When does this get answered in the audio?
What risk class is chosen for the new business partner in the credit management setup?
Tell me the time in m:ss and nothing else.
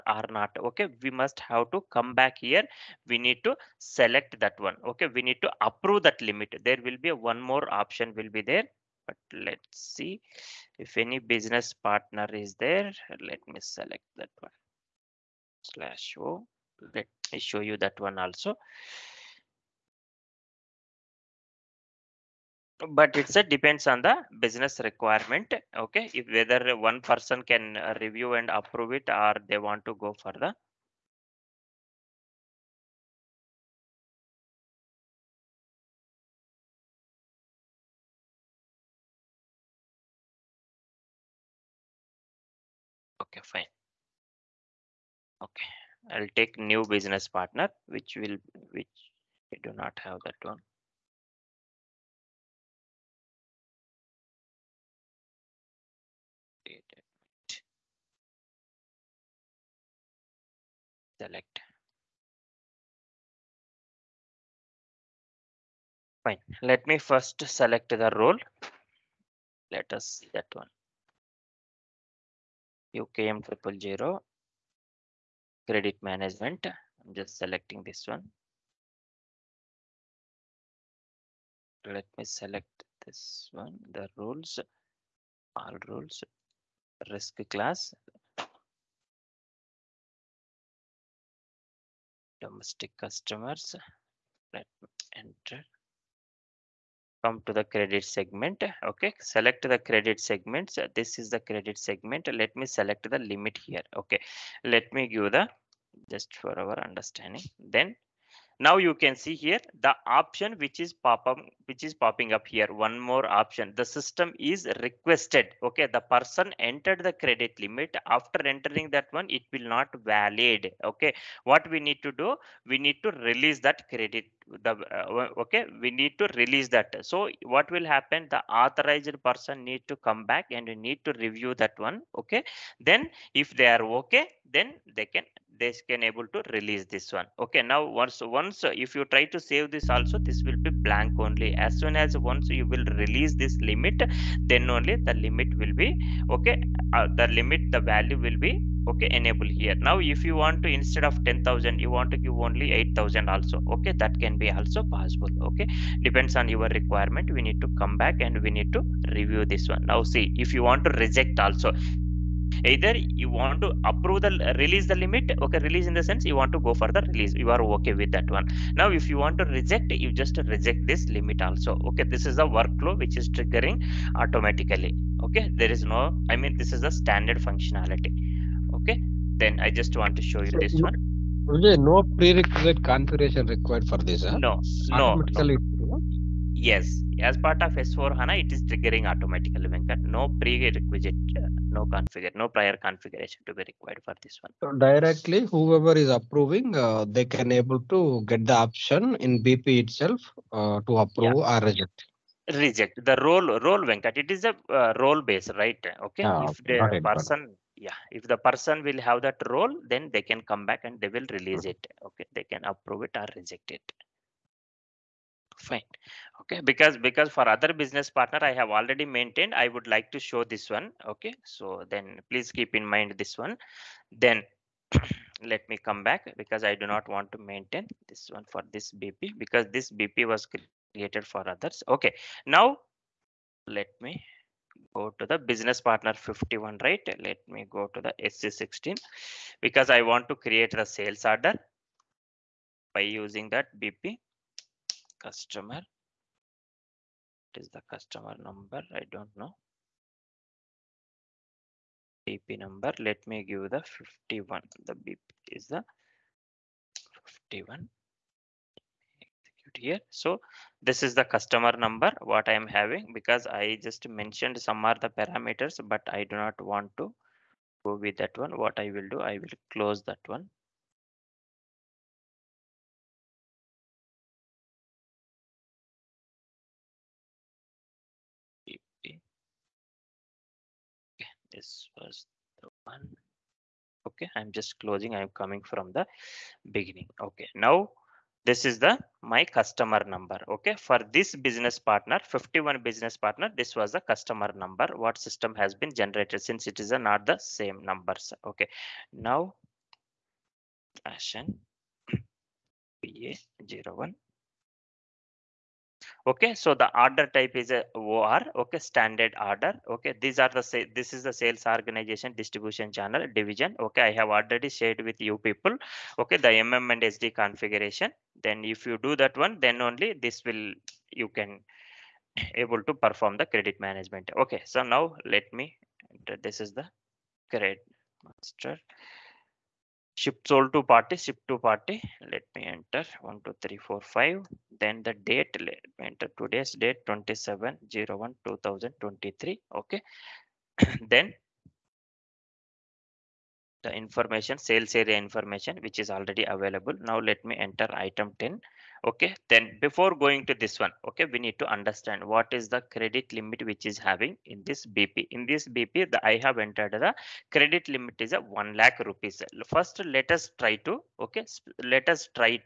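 1:32.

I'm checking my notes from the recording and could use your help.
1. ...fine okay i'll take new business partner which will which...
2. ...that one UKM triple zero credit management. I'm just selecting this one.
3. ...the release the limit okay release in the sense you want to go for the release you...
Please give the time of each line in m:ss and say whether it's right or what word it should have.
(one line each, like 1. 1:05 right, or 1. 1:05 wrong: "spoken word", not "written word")
1. 0:43 right
2. 1:10 right
3. 2:44 right.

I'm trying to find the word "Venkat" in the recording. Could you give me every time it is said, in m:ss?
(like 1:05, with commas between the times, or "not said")
3:09, 3:23.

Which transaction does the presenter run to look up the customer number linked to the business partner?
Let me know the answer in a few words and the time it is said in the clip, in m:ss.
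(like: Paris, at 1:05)
SC16, at 3:58.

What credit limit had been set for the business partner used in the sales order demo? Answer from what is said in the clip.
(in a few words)
1 lakh rupees.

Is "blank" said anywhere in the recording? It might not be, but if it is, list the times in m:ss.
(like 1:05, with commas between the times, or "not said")
2:20.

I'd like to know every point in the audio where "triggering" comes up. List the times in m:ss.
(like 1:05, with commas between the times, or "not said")
2:53, 3:08.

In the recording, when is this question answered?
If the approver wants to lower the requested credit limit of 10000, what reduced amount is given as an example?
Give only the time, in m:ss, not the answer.
2:32.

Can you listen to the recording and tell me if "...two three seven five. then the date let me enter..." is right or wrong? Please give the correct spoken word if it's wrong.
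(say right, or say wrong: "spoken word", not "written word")
wrong: "four", not "seven".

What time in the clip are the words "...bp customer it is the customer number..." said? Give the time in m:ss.
4:03.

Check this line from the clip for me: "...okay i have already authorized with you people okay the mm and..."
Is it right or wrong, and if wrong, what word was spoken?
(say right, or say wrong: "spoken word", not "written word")
wrong: "shared", not "authorized".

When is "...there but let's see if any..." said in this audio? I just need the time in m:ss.
0:08.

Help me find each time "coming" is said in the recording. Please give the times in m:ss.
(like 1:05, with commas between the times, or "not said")
4:45.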